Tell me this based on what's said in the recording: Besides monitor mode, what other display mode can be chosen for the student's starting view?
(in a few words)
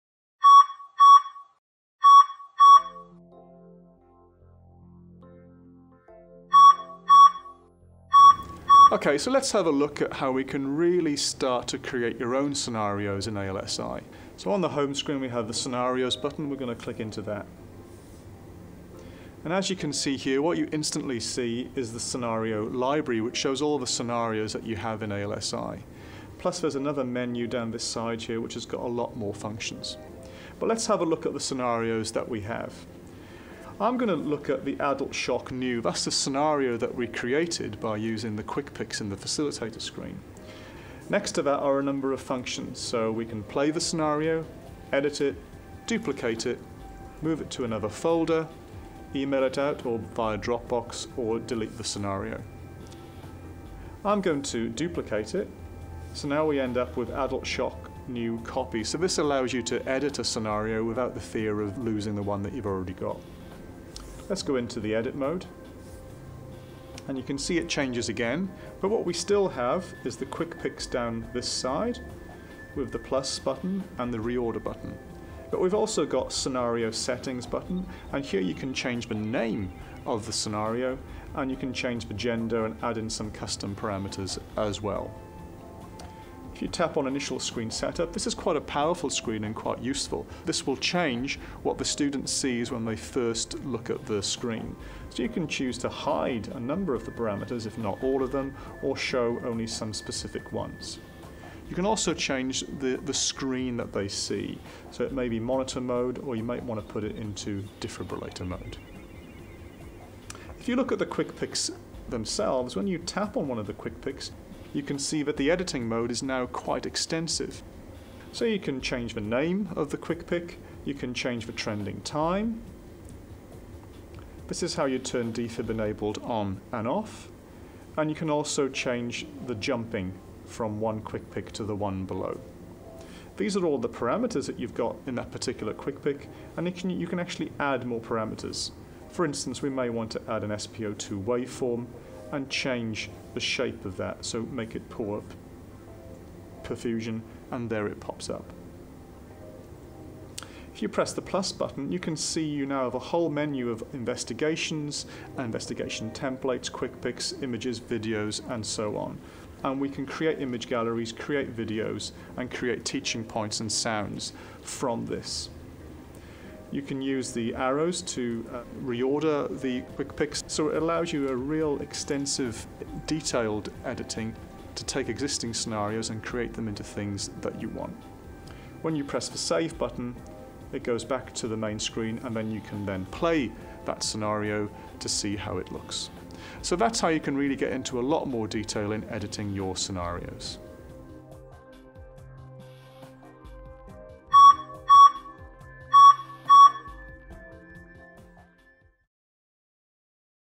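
defibrillator mode.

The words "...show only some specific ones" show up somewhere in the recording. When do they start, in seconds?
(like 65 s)
98 s.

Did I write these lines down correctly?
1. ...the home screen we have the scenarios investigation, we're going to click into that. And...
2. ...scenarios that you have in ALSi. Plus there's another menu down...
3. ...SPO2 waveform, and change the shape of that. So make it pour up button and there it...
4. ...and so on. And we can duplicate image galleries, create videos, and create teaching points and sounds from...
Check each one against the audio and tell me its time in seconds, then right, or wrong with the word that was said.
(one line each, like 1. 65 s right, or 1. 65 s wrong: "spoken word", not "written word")
1. 14 s wrong: "button", not "investigation"
2. 23 s right
3. 140 s wrong: "perfusion", not "button"
4. 158 s wrong: "create", not "duplicate".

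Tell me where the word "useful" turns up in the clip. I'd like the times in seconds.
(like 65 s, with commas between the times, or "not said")
89 s.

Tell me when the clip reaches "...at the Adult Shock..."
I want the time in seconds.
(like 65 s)
34 s.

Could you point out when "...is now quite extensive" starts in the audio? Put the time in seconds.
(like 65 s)
116 s.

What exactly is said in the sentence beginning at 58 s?
So this allows you to edit a scenario without the fear of losing the one that you've already got.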